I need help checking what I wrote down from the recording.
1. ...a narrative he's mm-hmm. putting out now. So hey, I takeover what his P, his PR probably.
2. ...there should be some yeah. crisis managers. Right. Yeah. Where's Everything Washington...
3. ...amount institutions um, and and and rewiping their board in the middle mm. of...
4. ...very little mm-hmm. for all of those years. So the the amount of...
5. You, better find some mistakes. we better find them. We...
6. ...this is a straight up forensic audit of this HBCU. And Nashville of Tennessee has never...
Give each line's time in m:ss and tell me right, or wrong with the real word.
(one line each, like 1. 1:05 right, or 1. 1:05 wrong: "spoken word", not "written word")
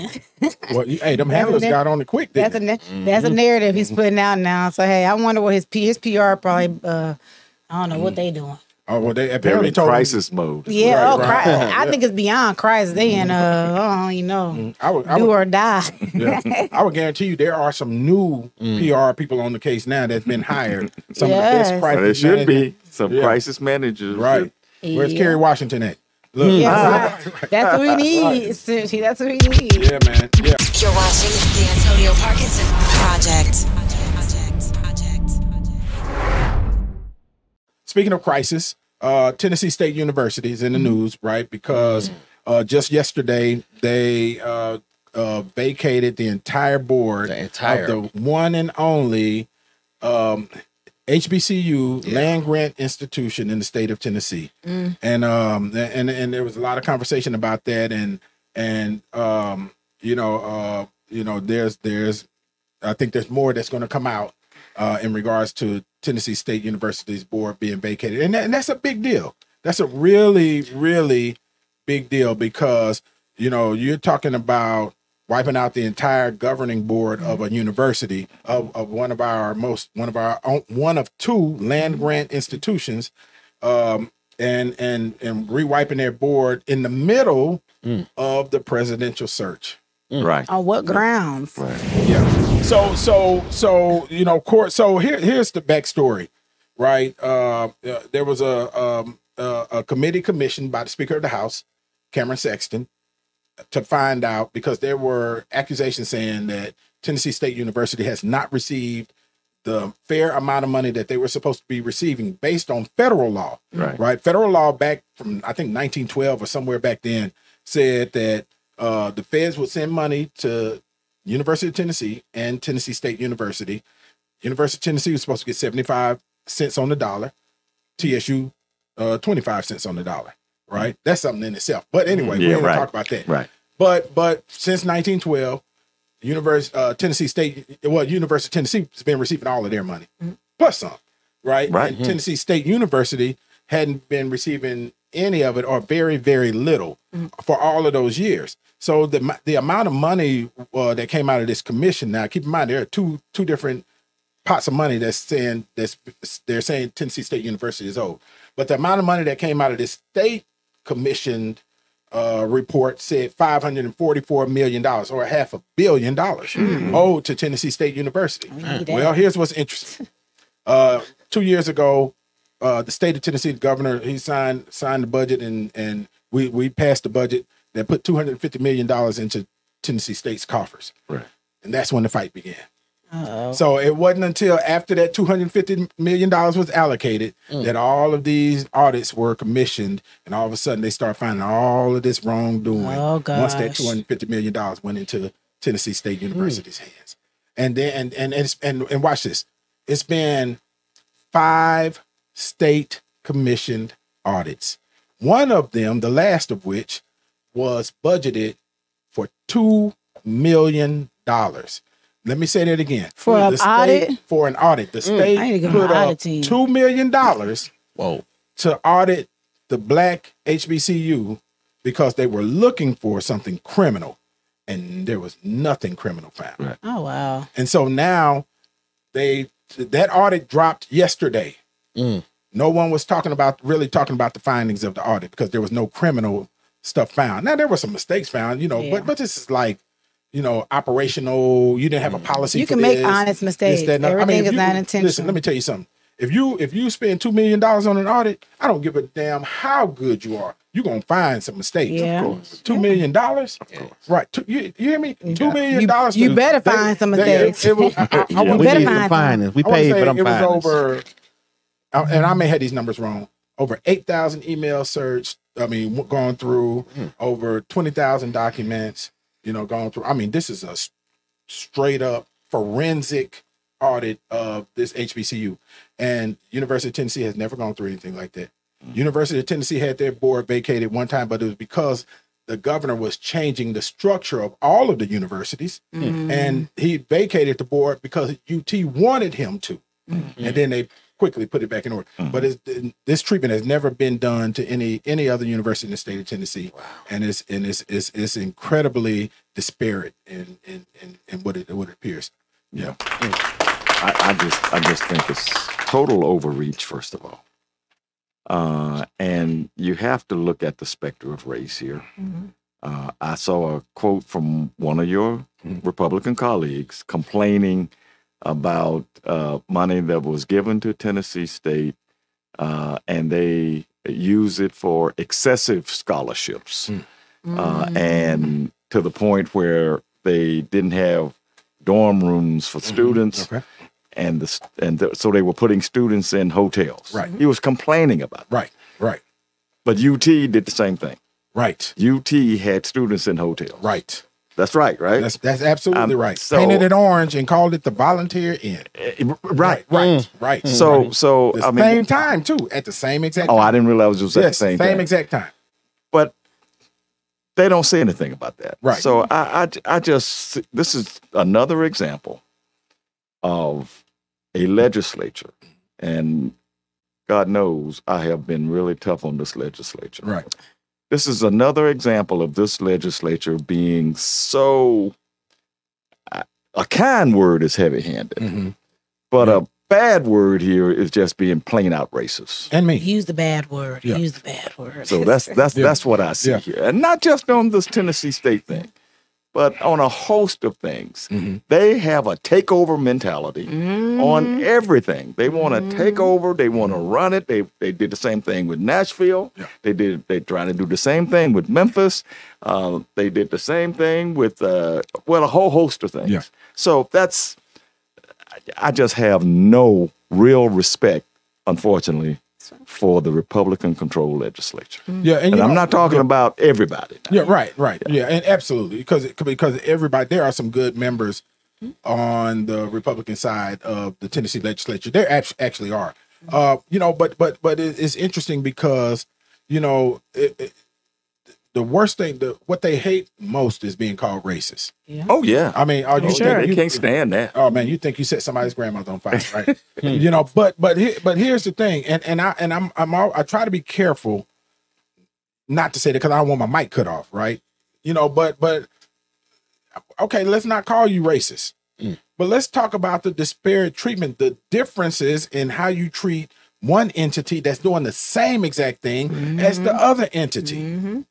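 1. 0:03 wrong: "wonder", not "takeover"
2. 0:22 wrong: "Kerry", not "Everything"
3. 1:21 wrong: "grant", not "amount"
4. 2:26 right
5. 4:16 right
6. 4:30 wrong: "University", not "Nashville".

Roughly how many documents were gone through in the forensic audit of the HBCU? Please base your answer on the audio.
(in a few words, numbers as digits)
over 20,000.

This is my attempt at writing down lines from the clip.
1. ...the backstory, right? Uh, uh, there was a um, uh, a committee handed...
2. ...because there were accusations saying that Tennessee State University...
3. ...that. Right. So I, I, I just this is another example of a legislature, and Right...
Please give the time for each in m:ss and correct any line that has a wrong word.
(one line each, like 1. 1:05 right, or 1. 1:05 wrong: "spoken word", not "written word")
1. 1:35 wrong: "commissioned", not "handed"
2. 1:44 right
3. 5:58 wrong: "God", not "Right".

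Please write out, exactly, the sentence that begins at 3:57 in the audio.
Now there were some mistakes found, you know, yeah.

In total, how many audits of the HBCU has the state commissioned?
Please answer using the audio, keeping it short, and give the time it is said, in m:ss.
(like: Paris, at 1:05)
5, at 3:21.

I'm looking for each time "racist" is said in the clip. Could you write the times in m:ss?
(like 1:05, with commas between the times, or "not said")
6:22, 7:14, 7:31.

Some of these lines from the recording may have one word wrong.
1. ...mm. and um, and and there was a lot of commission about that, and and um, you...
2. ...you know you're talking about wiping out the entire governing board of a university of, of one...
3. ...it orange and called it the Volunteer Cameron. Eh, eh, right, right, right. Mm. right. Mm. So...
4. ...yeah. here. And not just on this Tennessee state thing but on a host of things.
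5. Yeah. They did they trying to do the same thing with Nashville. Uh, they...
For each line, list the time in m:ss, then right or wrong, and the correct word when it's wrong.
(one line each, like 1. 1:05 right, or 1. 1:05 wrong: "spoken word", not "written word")
1. 0:54 wrong: "conversation", not "commission"
2. 1:13 right
3. 5:46 wrong: "Inn", not "Cameron"
4. 6:26 right
5. 6:39 wrong: "Memphis", not "Nashville".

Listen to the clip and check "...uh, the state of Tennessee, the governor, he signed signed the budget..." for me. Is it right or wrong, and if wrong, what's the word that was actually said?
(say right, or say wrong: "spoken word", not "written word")
right.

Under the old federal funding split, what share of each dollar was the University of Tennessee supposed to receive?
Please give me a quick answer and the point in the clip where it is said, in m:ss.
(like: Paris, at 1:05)
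75 cents, at 2:05.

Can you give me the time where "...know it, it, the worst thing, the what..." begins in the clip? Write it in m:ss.
7:09.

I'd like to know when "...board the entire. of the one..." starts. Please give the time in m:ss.
0:46.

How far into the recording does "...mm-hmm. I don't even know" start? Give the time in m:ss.
0:13.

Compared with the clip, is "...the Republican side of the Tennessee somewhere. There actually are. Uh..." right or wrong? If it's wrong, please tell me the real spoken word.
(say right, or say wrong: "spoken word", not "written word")
wrong: "legislature", not "somewhere".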